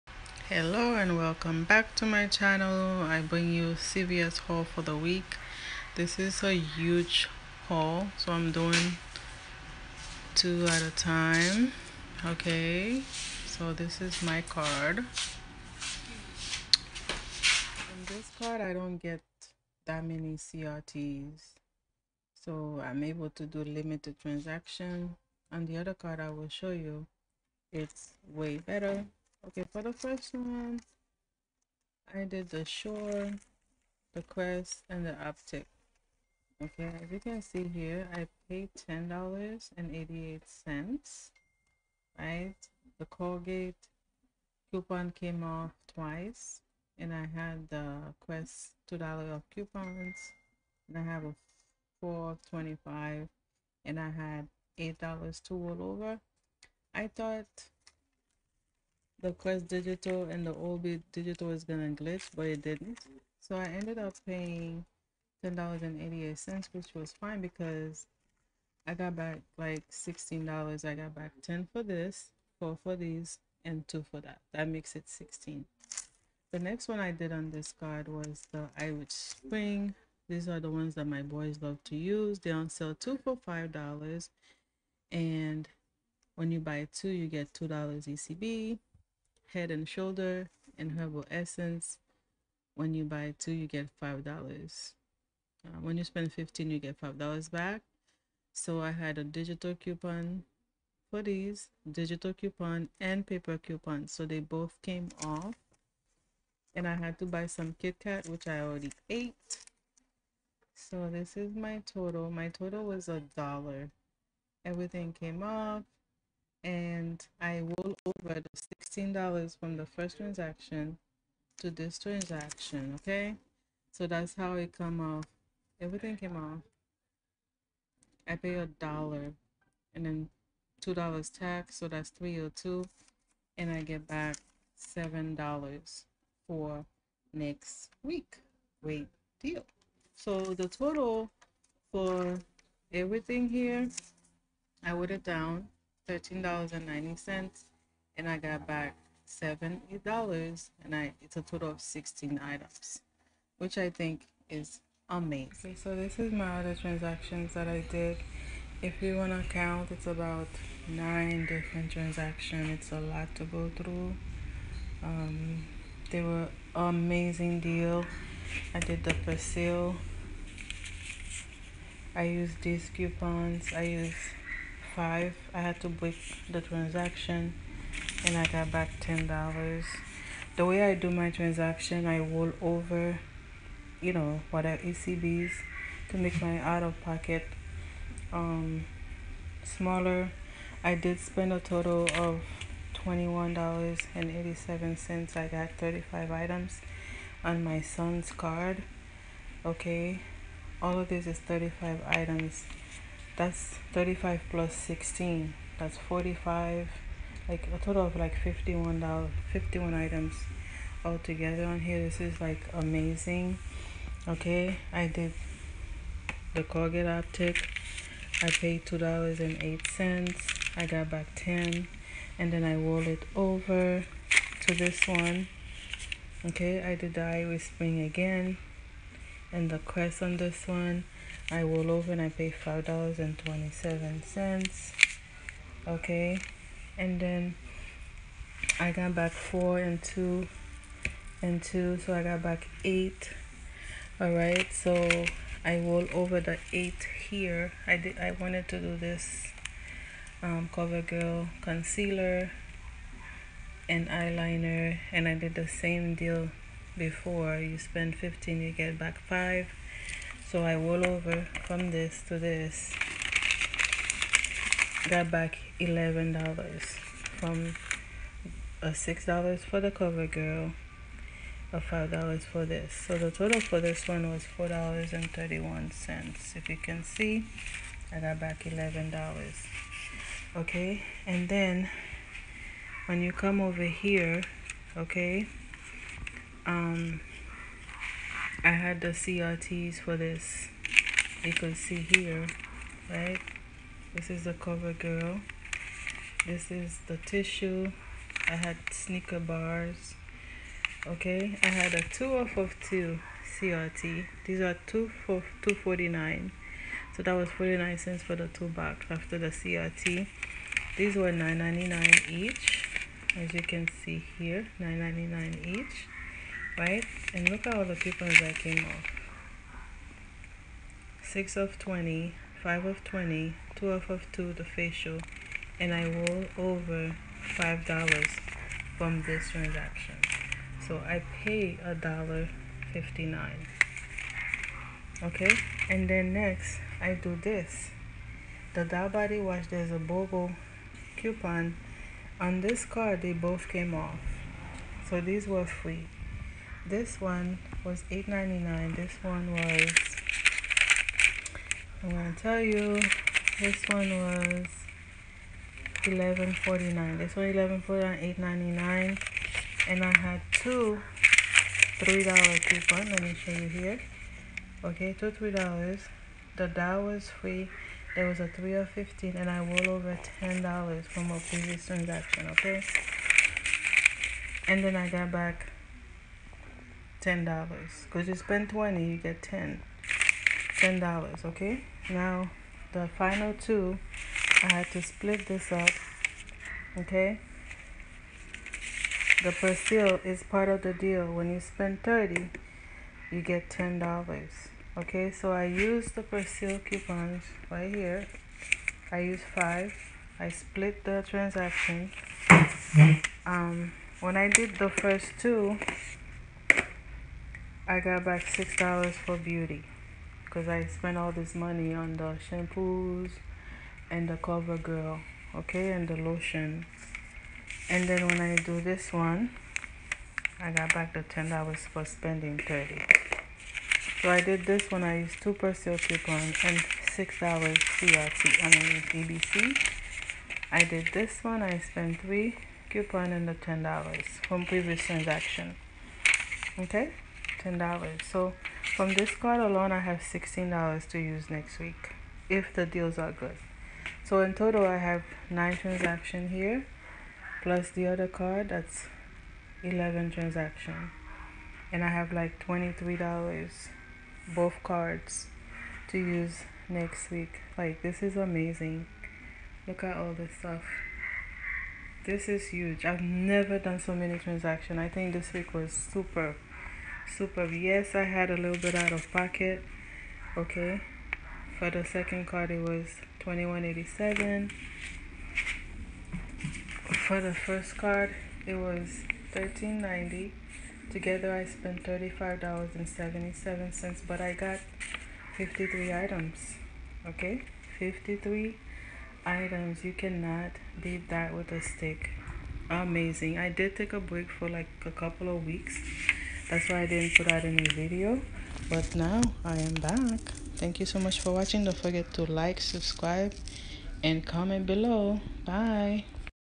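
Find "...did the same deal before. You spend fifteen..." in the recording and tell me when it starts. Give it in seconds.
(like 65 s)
255 s.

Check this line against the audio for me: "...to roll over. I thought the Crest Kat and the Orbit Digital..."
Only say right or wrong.
wrong.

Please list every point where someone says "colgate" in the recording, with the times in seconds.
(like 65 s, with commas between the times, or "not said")
43 s, 216 s.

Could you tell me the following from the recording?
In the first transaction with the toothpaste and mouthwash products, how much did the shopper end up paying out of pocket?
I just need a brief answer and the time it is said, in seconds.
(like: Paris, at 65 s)
$10.88, at 38 s.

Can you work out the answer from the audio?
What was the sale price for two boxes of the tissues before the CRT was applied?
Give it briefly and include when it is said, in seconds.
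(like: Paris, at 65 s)
$2.49, at 305 s.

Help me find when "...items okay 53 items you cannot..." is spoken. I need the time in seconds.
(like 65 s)
486 s.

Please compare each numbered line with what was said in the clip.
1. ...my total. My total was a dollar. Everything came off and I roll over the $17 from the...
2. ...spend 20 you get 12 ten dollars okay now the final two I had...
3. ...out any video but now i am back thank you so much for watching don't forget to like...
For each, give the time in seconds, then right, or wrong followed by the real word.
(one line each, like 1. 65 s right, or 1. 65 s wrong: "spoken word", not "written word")
1. 111 s wrong: "16", not "17"
2. 378 s wrong: "10", not "12"
3. 497 s right.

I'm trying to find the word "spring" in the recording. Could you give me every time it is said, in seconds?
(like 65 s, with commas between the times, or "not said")
79 s, 227 s.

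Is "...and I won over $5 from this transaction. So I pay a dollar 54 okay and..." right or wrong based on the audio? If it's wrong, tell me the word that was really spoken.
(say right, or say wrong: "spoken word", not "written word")
wrong: "59", not "54".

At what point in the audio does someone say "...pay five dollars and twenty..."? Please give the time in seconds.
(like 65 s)
232 s.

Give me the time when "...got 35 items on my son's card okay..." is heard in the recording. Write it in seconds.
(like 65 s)
195 s.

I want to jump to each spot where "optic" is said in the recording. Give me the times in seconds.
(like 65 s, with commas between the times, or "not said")
35 s, 217 s.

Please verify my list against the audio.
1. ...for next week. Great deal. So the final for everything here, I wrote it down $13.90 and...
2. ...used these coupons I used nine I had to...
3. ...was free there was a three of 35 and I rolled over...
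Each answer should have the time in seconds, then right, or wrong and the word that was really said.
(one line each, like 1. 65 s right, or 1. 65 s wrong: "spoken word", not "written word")
1. 136 s wrong: "total", not "final"
2. 172 s wrong: "five", not "nine"
3. 367 s wrong: "15", not "35".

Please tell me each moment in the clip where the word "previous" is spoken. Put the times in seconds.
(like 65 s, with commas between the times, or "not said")
371 s, 434 s.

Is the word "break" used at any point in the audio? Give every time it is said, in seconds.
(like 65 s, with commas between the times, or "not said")
175 s, 494 s.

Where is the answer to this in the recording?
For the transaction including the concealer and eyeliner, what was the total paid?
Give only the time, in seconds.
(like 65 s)
274 s.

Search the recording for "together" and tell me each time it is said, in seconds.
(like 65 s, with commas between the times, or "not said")
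211 s, 481 s.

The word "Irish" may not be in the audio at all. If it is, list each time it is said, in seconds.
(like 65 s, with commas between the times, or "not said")
78 s, 227 s.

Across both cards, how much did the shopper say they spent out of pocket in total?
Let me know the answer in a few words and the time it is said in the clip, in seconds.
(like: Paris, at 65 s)
$35.77, at 482 s.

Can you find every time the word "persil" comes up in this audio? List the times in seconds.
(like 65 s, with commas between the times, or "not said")
389 s, 396 s, 425 s.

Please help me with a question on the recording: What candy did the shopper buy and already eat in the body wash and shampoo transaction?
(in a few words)
Kit Kat.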